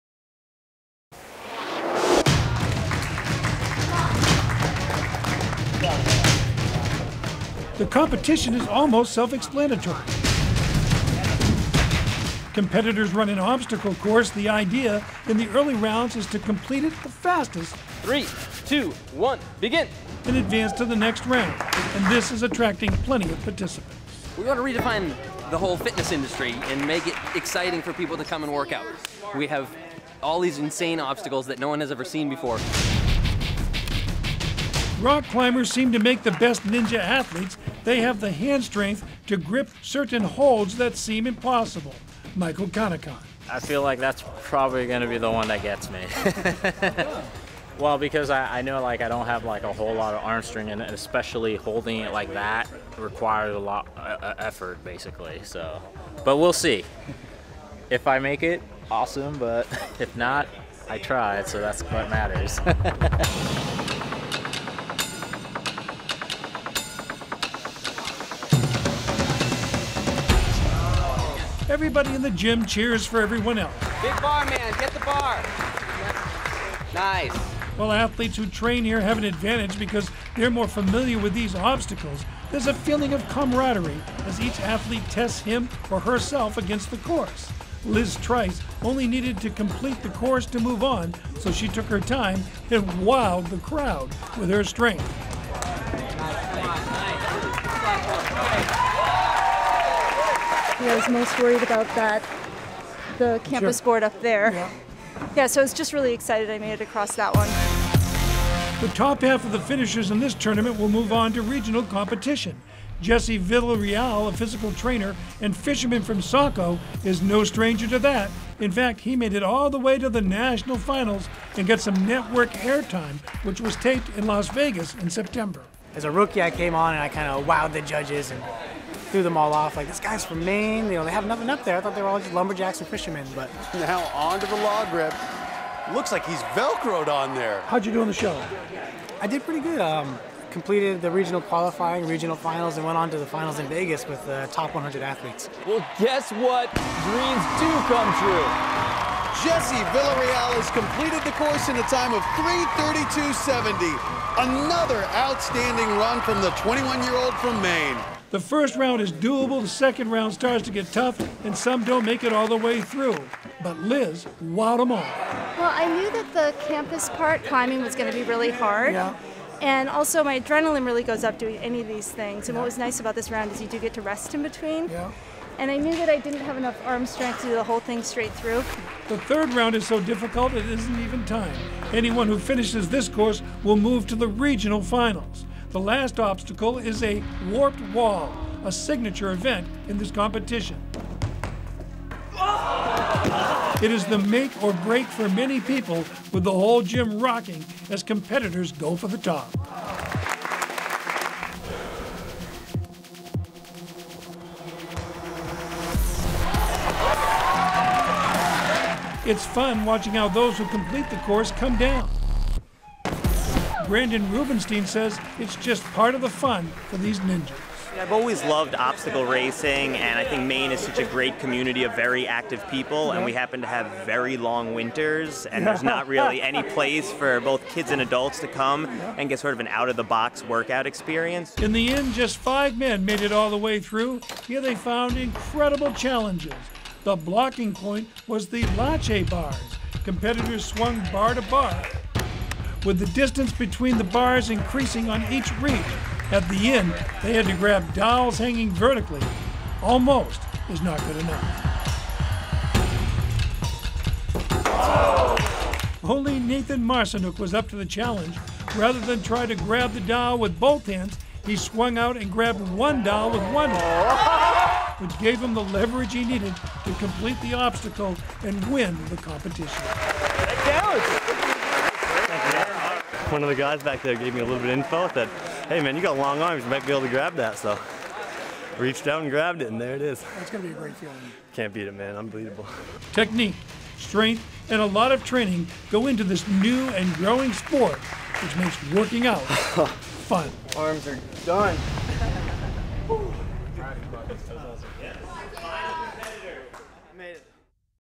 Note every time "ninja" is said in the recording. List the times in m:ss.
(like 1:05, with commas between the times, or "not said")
0:36, 3:37.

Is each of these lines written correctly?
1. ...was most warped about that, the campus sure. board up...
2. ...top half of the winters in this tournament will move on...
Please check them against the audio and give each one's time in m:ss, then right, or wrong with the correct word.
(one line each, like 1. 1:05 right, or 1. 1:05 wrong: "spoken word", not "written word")
1. 1:40 wrong: "worried", not "warped"
2. 1:48 wrong: "finishers", not "winters".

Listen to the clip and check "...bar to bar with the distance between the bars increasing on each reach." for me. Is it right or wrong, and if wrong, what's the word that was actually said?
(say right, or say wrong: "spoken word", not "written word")
right.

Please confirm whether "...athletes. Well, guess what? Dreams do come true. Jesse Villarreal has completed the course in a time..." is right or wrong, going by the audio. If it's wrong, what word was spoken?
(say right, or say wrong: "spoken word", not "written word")
right.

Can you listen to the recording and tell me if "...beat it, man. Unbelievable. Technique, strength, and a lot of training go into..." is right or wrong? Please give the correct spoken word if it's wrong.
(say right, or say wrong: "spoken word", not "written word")
right.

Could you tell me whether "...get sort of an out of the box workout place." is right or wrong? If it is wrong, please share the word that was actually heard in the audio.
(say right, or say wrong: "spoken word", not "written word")
wrong: "experience", not "place".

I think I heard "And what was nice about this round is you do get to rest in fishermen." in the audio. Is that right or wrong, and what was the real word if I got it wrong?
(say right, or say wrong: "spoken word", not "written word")
wrong: "between", not "fishermen".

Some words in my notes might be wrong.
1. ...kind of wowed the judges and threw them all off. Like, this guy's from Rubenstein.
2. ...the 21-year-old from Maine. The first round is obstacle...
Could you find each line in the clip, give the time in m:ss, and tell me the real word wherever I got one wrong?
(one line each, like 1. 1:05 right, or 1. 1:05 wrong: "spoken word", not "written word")
1. 2:07 wrong: "Maine", not "Rubenstein"
2. 2:36 wrong: "doable", not "obstacle".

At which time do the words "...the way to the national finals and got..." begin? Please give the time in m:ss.
1:59.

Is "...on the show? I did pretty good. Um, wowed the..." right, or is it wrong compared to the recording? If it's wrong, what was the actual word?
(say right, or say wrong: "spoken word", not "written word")
wrong: "completed", not "wowed".